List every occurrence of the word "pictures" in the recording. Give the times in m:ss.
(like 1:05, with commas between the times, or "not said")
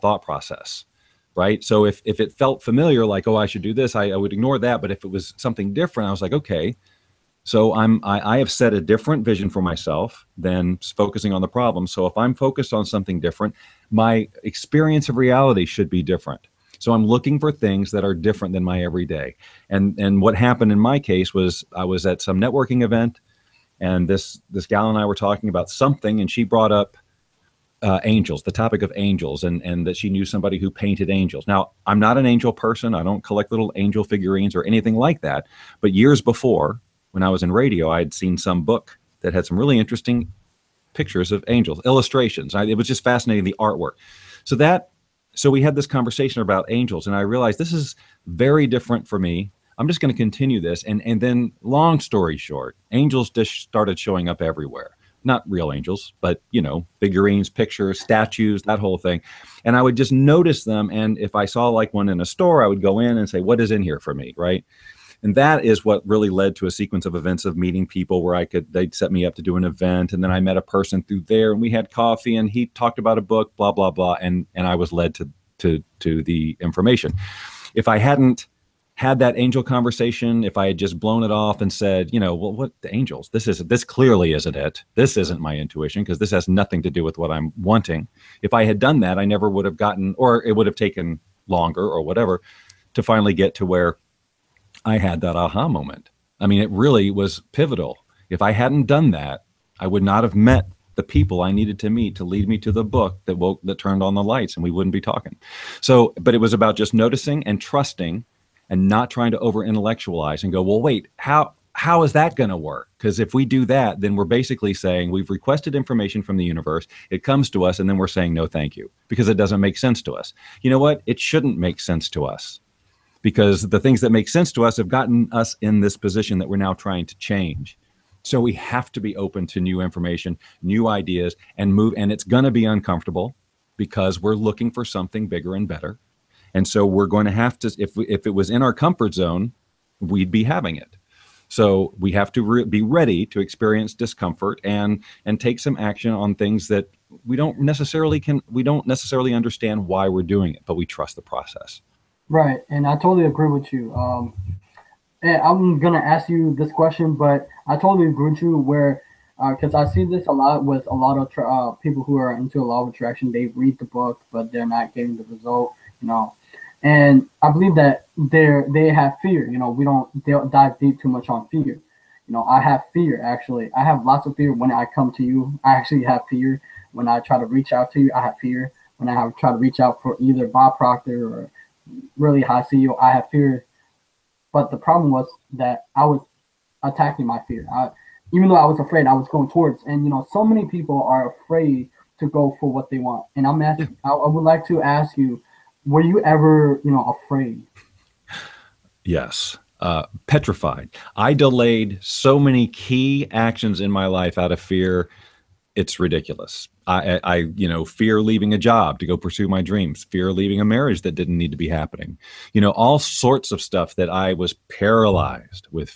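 0:40, 0:57.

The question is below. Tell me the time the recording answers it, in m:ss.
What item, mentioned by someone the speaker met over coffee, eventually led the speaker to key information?
1:13.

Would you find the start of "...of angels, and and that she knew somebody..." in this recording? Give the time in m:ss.
0:28.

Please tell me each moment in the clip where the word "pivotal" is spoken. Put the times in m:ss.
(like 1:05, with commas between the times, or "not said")
1:37.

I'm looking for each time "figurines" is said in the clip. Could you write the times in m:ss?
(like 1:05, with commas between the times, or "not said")
0:34, 0:56.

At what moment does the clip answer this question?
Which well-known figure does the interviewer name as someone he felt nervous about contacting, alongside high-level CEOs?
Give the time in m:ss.
3:00.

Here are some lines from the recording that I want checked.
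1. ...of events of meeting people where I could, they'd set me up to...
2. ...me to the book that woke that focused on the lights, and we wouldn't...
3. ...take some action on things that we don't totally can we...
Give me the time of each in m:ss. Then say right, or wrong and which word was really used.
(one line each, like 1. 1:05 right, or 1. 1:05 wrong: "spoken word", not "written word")
1. 1:07 right
2. 1:42 wrong: "turned", not "focused"
3. 2:25 wrong: "necessarily", not "totally".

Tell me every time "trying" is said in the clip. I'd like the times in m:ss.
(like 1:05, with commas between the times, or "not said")
1:49, 2:06.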